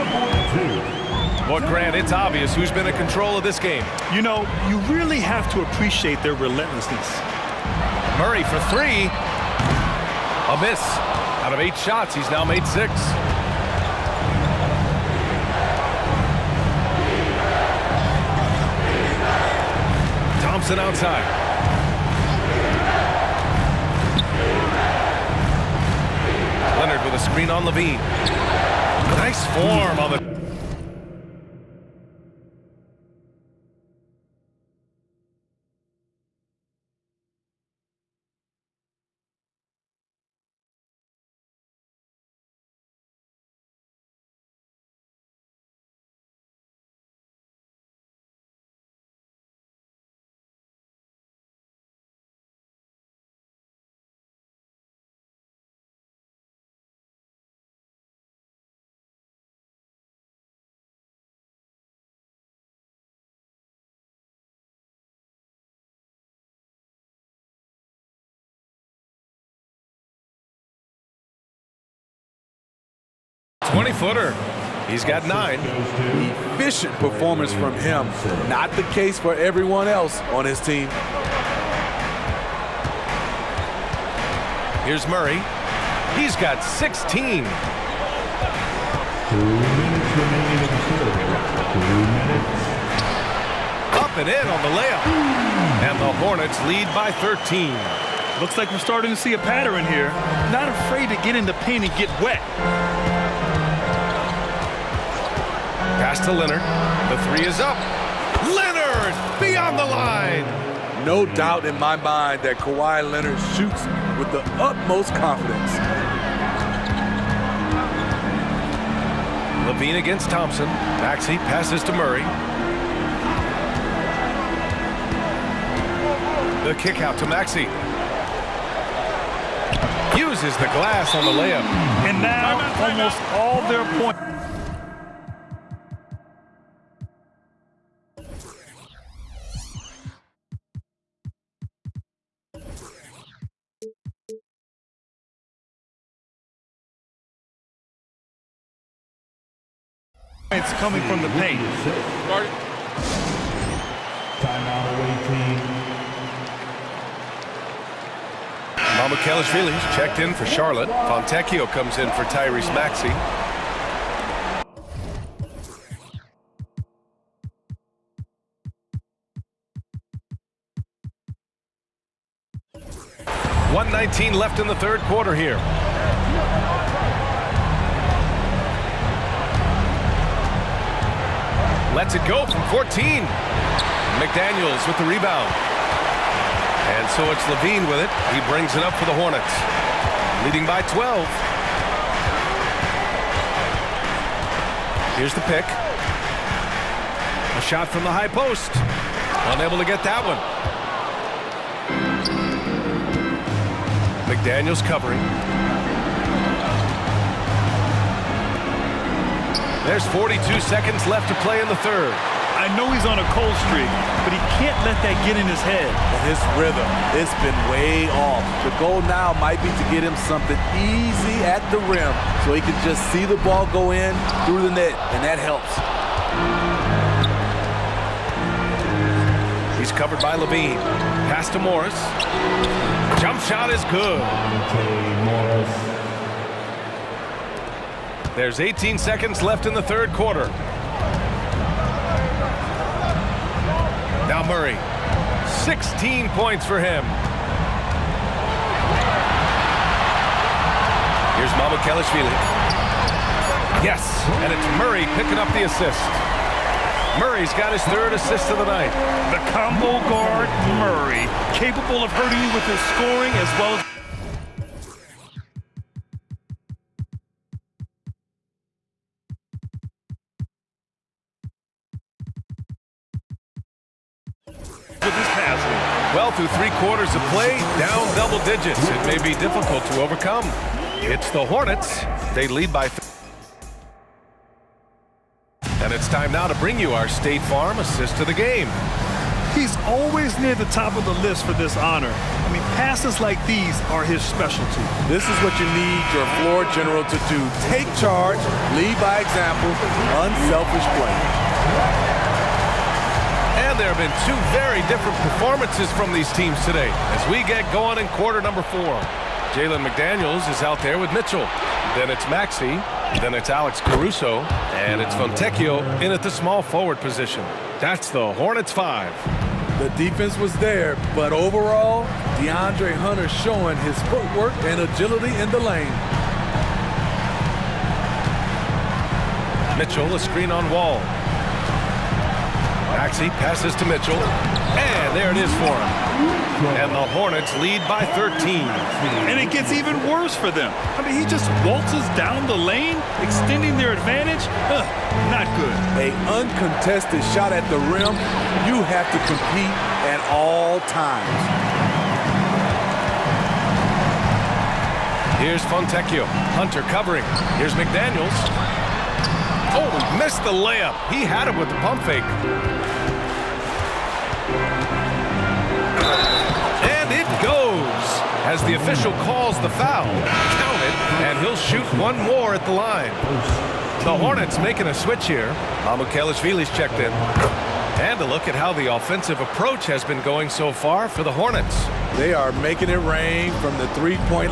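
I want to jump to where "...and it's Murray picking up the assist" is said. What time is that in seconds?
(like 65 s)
254 s.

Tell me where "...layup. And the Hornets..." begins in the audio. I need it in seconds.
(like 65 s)
94 s.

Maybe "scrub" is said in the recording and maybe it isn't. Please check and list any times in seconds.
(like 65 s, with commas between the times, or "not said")
not said.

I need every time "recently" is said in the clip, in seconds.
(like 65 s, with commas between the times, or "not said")
not said.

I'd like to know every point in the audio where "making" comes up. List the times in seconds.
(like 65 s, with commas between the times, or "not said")
374 s, 382 s.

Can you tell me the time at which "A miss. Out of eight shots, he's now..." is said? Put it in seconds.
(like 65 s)
10 s.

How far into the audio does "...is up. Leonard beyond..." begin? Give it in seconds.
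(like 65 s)
107 s.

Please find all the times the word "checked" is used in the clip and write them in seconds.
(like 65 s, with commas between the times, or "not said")
159 s, 376 s.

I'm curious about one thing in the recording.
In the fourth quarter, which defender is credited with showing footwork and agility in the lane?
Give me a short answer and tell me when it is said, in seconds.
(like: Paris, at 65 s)
DeAndre Hunter, at 322 s.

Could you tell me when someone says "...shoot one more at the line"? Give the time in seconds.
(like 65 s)
371 s.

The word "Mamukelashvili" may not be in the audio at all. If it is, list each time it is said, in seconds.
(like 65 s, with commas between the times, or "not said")
251 s, 375 s.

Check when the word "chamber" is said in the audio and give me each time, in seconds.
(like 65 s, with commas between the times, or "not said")
not said.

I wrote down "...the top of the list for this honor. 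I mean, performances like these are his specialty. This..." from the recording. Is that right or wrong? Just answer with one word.
wrong.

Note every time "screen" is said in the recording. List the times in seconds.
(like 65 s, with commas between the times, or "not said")
27 s, 330 s.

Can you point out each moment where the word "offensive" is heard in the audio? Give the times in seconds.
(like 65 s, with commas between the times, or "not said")
378 s.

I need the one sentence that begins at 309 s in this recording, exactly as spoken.
Jalen McDaniels is out there with Mitchell.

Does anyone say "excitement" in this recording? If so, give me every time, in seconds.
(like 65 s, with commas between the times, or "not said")
not said.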